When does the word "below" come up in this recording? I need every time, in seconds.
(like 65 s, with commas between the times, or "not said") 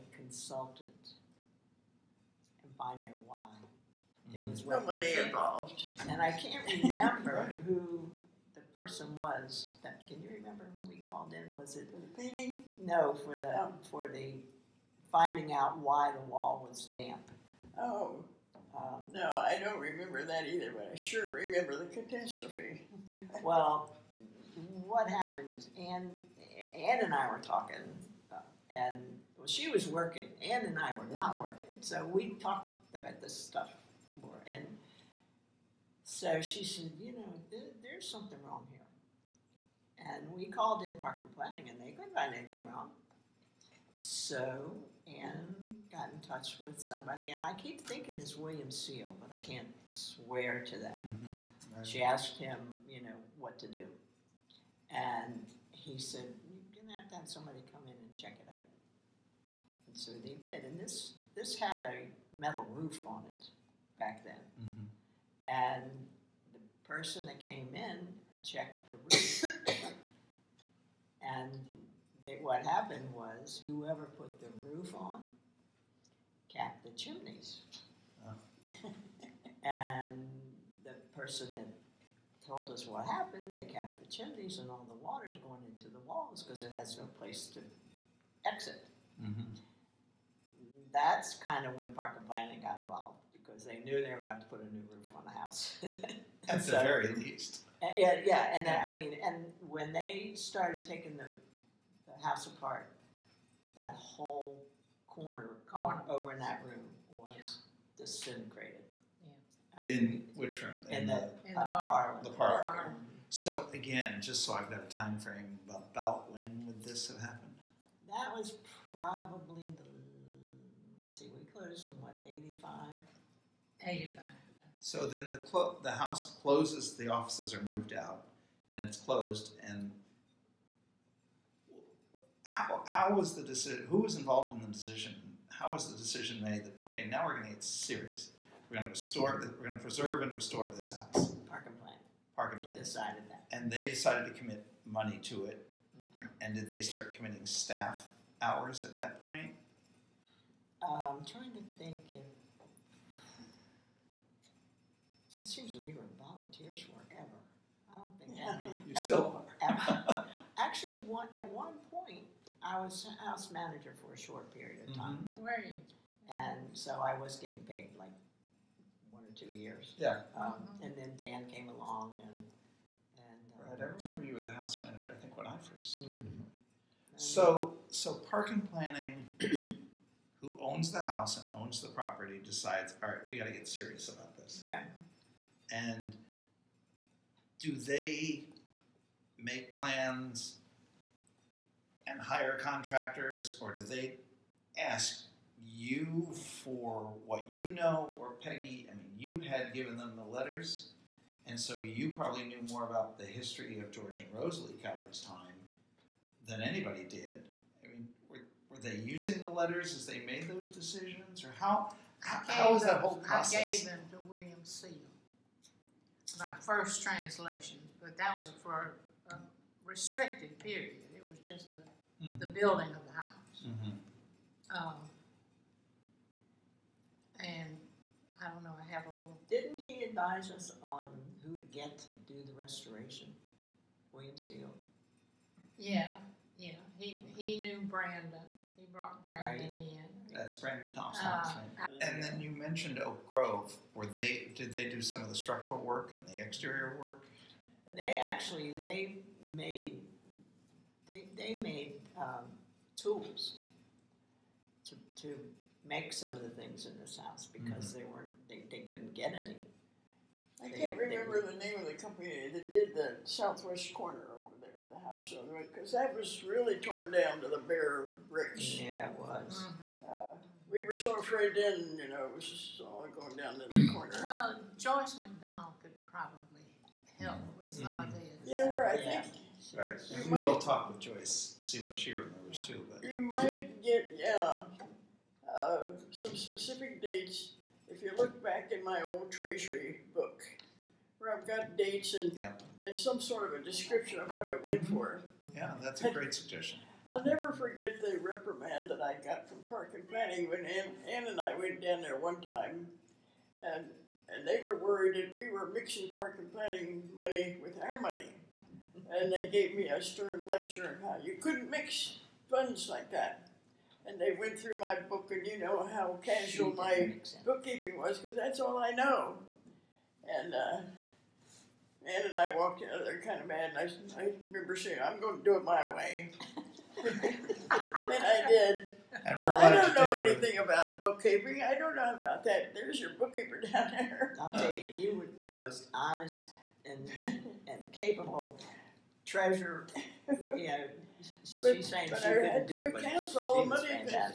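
not said.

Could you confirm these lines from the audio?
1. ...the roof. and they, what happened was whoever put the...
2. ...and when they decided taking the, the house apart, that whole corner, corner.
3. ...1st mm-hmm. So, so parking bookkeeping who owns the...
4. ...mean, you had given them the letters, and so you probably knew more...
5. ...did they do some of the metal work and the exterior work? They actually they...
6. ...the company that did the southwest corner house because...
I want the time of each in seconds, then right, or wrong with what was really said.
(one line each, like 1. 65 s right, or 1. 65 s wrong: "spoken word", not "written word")
1. 68 s right
2. 99 s wrong: "started", not "decided"
3. 175 s wrong: "planning", not "bookkeeping"
4. 198 s right
5. 244 s wrong: "structural", not "metal"
6. 261 s right.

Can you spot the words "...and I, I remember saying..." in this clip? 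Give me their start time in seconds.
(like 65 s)
323 s.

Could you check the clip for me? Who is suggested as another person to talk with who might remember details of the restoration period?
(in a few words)
Joyce McDonald.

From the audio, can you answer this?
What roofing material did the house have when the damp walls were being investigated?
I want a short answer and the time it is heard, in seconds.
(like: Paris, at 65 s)
Metal, at 62 s.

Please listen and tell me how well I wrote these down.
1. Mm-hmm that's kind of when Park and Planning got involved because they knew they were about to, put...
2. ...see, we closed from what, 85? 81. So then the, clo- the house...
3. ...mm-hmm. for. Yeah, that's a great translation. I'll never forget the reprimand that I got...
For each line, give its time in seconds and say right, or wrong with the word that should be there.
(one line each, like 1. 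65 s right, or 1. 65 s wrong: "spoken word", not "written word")
1. 89 s right
2. 121 s wrong: "85", not "81"
3. 294 s wrong: "suggestion", not "translation".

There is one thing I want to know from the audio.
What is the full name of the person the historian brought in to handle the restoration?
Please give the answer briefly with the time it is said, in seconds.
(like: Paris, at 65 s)
Brandon Thompson, at 240 s.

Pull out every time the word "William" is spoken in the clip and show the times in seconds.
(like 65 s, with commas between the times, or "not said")
48 s, 214 s, 234 s.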